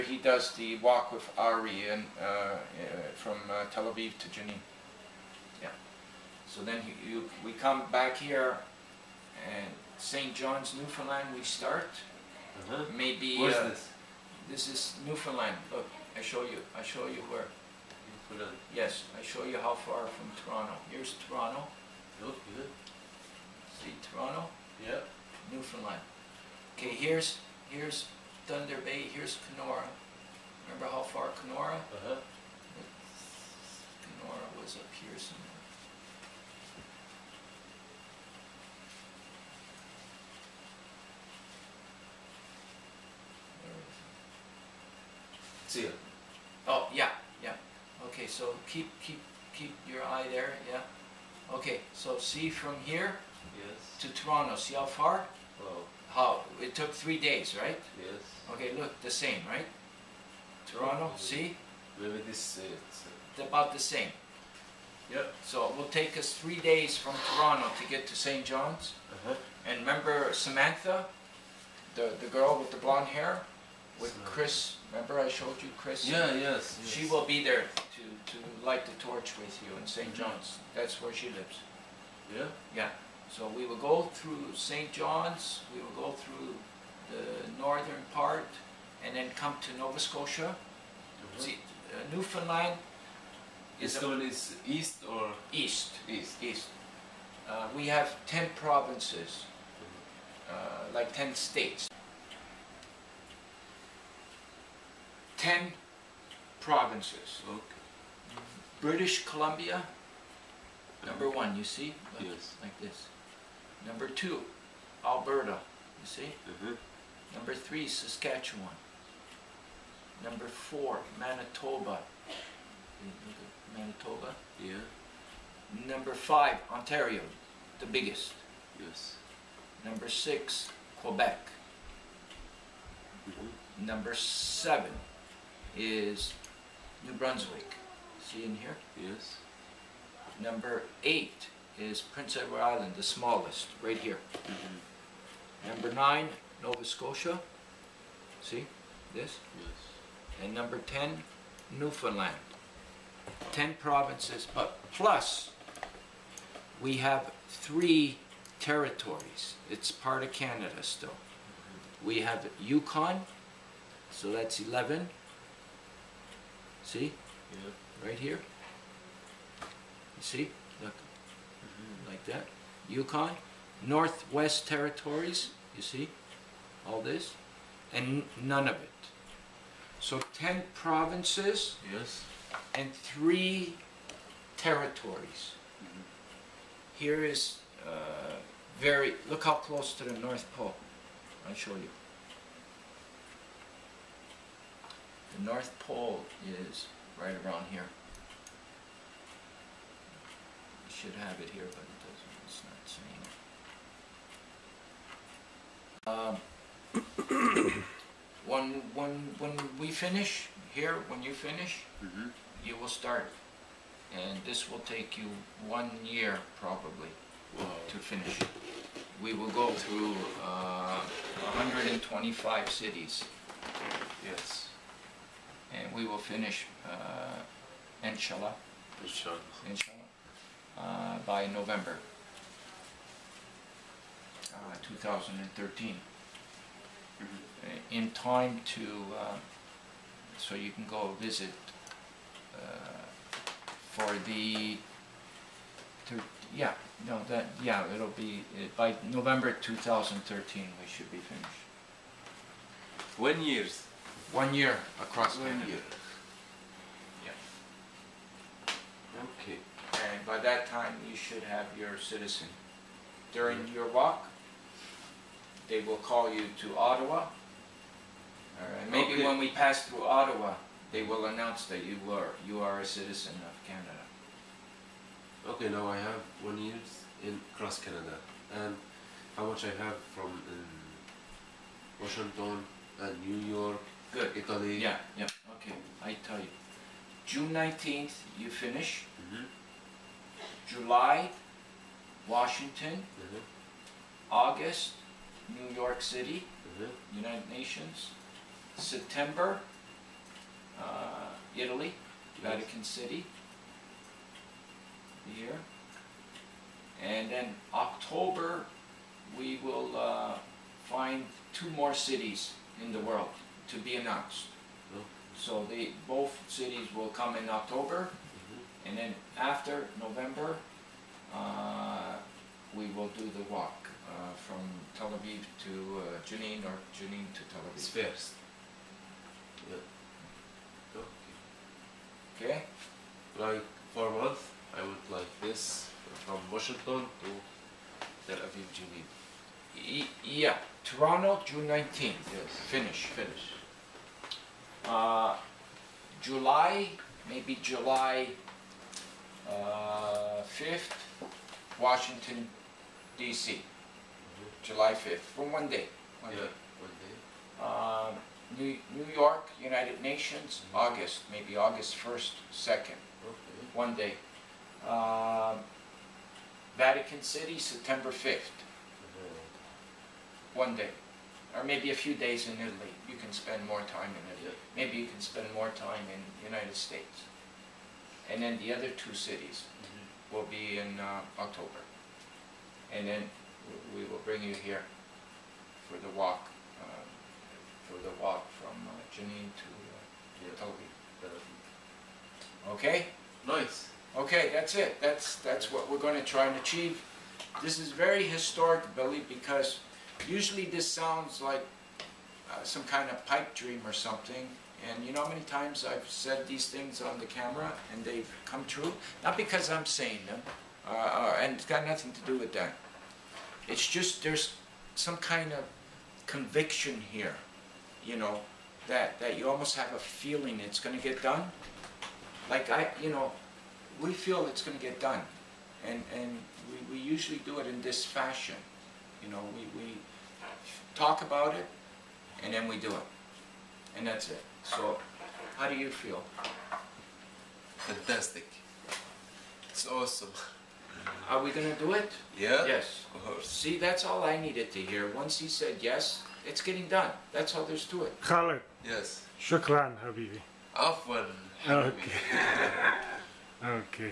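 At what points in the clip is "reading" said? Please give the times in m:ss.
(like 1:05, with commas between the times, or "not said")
not said.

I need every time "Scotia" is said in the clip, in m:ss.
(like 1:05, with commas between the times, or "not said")
1:29, 2:26.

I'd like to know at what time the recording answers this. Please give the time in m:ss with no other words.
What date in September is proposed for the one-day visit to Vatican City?
6:07.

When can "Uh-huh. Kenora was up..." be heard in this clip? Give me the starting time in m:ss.
0:31.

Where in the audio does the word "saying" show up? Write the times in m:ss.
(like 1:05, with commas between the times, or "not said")
3:27, 6:49.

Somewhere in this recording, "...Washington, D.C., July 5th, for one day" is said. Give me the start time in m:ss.
5:51.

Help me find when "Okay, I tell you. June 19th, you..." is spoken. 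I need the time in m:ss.
4:45.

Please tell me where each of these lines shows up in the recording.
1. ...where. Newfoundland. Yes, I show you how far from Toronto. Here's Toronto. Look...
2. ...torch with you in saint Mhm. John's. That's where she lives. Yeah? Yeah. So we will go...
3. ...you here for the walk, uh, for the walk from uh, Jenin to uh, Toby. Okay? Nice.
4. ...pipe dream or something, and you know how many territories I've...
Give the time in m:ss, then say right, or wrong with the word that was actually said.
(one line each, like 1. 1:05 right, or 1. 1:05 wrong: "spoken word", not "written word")
1. 0:17 right
2. 1:19 right
3. 6:24 right
4. 6:43 wrong: "times", not "territories".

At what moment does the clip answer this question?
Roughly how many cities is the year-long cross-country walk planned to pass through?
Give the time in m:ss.
3:41.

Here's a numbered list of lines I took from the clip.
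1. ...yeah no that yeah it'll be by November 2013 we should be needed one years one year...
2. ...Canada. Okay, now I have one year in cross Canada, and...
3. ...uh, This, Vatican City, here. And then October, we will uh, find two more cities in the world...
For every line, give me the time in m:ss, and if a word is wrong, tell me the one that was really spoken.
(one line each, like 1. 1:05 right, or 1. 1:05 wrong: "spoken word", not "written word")
1. 4:06 wrong: "finished", not "needed"
2. 4:33 right
3. 5:00 wrong: "Italy", not "This".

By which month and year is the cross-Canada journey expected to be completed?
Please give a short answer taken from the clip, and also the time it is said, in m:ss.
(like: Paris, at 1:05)
November 2013, at 3:51.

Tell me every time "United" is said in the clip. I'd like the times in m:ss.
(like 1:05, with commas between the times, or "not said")
4:57, 5:59, 6:16.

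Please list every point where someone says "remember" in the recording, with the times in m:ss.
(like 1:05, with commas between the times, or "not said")
0:30, 1:09, 1:14.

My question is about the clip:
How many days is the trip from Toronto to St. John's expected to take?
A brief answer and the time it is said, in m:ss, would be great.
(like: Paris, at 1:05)
3 days, at 1:06.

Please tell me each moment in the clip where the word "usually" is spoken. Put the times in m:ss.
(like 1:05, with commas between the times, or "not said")
6:40, 7:07.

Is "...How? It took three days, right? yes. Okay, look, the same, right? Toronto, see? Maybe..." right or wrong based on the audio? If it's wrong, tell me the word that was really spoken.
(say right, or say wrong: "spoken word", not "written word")
right.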